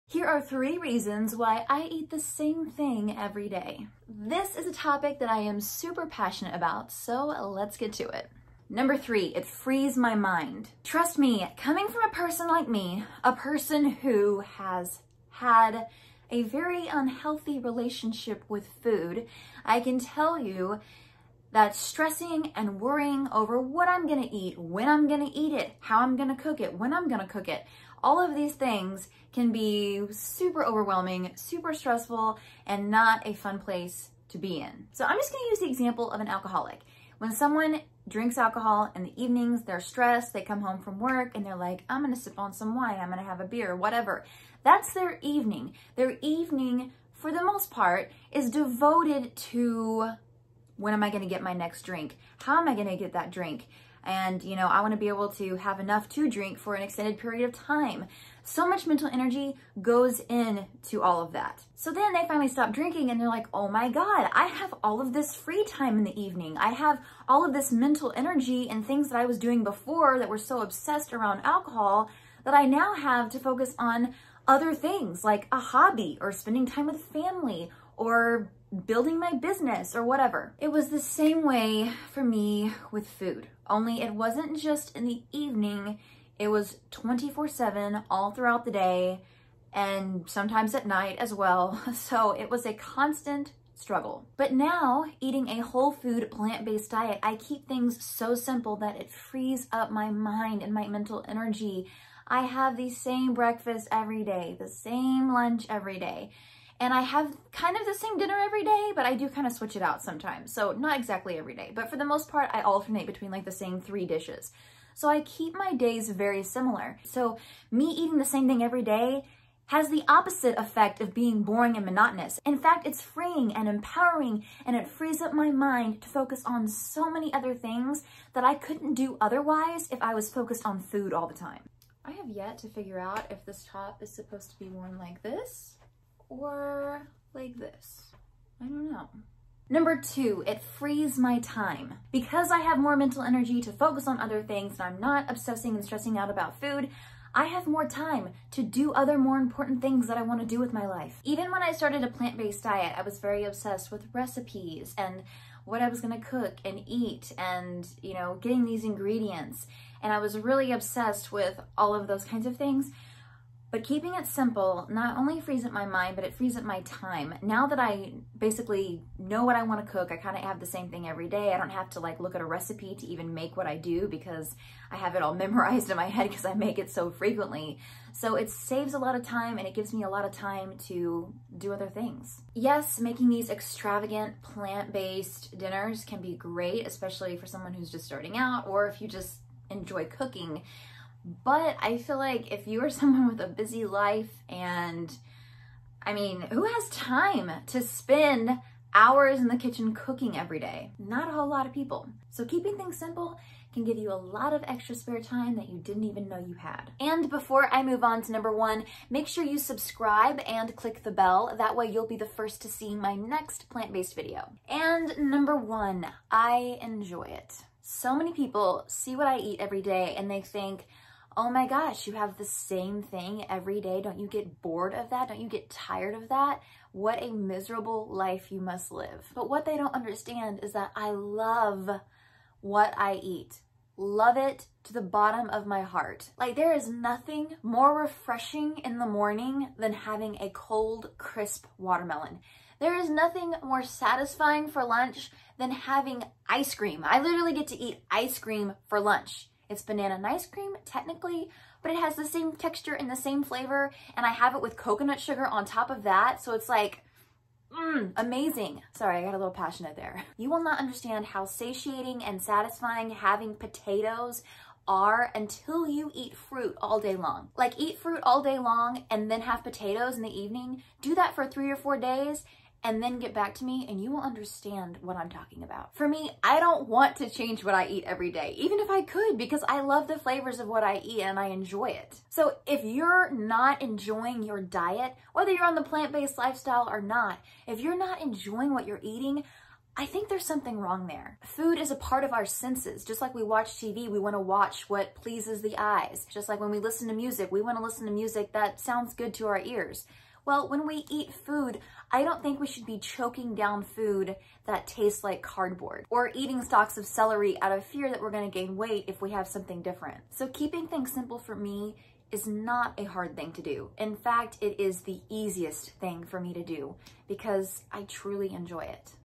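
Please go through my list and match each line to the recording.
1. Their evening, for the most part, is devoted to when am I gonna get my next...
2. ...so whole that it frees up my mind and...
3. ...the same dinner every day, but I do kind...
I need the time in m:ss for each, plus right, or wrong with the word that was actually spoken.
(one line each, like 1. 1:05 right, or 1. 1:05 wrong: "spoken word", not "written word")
1. 0:45 right
2. 1:38 wrong: "simple", not "whole"
3. 1:47 right.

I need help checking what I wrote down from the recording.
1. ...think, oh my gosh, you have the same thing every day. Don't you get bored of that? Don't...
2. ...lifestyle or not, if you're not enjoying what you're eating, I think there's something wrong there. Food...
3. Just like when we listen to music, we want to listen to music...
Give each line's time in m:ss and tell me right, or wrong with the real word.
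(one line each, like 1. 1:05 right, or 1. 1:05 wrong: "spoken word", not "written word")
1. 3:40 right
2. 4:46 right
3. 4:56 right.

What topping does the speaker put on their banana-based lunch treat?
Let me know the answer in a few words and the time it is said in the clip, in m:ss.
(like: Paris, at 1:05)
Coconut sugar, at 4:14.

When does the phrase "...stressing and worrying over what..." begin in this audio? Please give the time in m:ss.
0:21.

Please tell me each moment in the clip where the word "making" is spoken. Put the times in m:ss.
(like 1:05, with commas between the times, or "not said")
3:02.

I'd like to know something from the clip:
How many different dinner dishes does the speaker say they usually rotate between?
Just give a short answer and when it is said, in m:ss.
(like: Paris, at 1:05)
3, at 1:53.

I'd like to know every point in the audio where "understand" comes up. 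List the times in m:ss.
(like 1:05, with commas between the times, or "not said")
3:49, 4:20, 4:34.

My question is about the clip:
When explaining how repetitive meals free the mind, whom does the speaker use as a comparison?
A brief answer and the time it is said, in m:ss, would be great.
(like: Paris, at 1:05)
An alcoholic, at 0:36.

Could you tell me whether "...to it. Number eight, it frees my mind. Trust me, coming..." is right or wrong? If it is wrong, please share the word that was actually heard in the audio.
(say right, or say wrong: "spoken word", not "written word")
wrong: "three", not "eight".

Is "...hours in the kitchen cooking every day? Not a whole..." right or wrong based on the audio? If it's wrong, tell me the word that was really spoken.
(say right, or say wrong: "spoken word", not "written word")
right.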